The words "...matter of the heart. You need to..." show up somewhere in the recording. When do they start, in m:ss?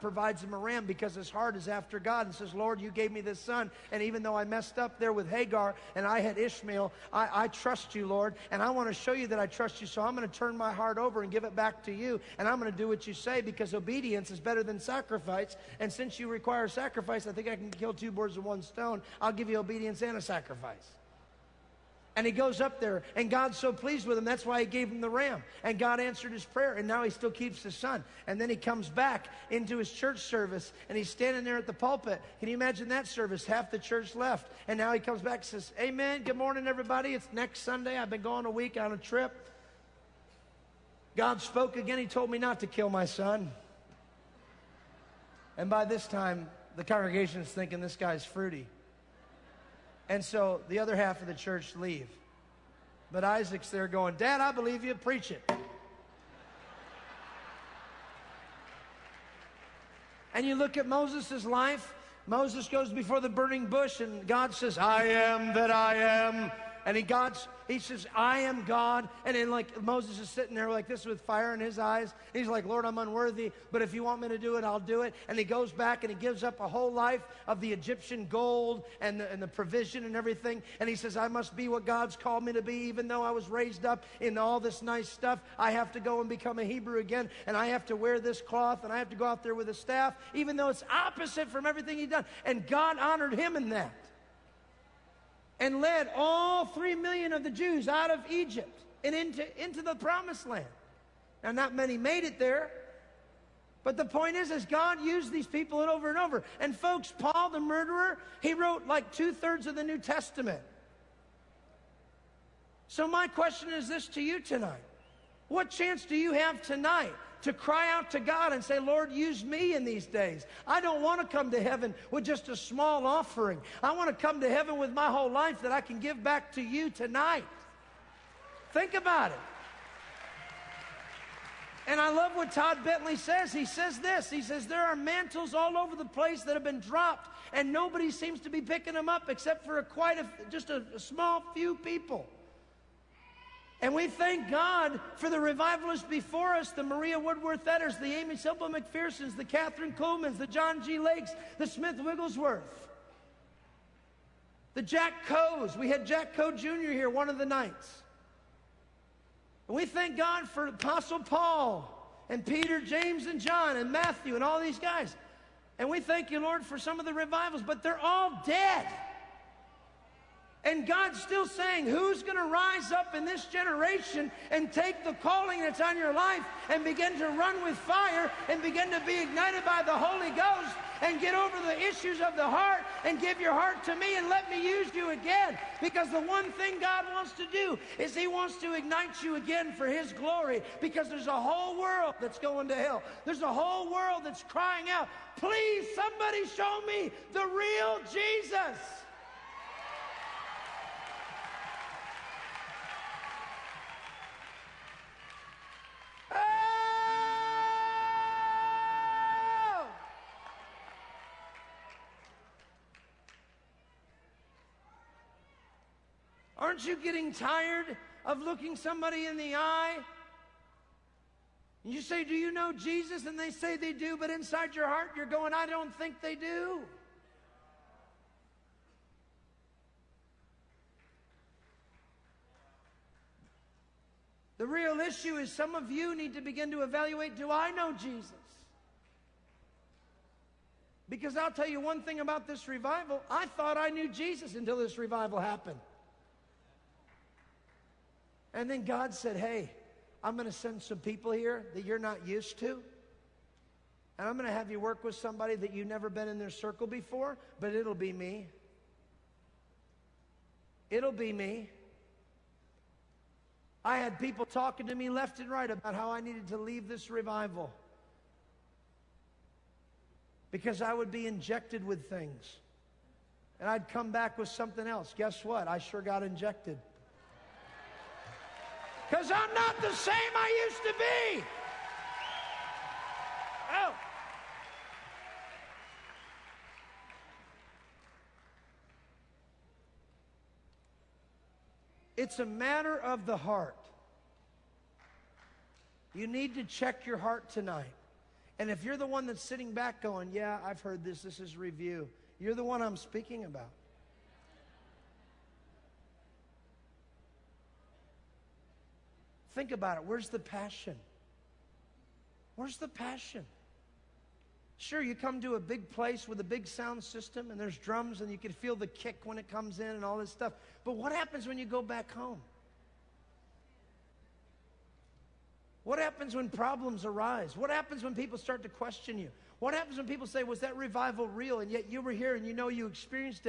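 4:52.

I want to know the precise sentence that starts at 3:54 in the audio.
The real issue is some of you need to begin to evaluate do I know Jesus?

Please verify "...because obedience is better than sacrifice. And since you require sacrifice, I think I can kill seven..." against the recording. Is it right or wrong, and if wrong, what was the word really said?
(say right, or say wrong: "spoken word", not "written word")
wrong: "two", not "seven".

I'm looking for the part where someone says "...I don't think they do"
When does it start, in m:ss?
3:45.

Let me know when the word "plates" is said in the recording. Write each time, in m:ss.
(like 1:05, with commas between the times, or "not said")
not said.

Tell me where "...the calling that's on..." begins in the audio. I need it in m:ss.
2:55.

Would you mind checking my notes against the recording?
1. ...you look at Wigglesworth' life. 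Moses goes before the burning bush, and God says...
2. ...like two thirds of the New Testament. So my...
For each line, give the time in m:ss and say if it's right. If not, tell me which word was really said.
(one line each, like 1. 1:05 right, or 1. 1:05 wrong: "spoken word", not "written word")
1. 1:00 wrong: "Moses", not "Wigglesworth"
2. 1:48 right.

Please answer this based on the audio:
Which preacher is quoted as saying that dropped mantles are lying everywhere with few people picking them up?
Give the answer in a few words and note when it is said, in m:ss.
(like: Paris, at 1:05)
Todd Bentley, at 2:12.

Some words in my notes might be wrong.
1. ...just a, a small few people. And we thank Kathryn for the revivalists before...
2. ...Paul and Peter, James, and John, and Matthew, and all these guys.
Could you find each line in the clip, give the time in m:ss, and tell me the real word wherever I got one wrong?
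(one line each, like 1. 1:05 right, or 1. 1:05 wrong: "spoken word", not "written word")
1. 2:20 wrong: "God", not "Kathryn"
2. 2:41 right.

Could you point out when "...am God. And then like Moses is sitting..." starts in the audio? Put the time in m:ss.
1:08.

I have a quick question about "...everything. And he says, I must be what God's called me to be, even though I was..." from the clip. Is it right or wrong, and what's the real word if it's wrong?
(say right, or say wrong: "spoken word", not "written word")
right.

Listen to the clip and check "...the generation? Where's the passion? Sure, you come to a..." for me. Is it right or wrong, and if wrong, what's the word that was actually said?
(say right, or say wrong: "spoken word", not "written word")
wrong: "passion", not "generation".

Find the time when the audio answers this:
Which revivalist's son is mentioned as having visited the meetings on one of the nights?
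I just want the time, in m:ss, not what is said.
2:36.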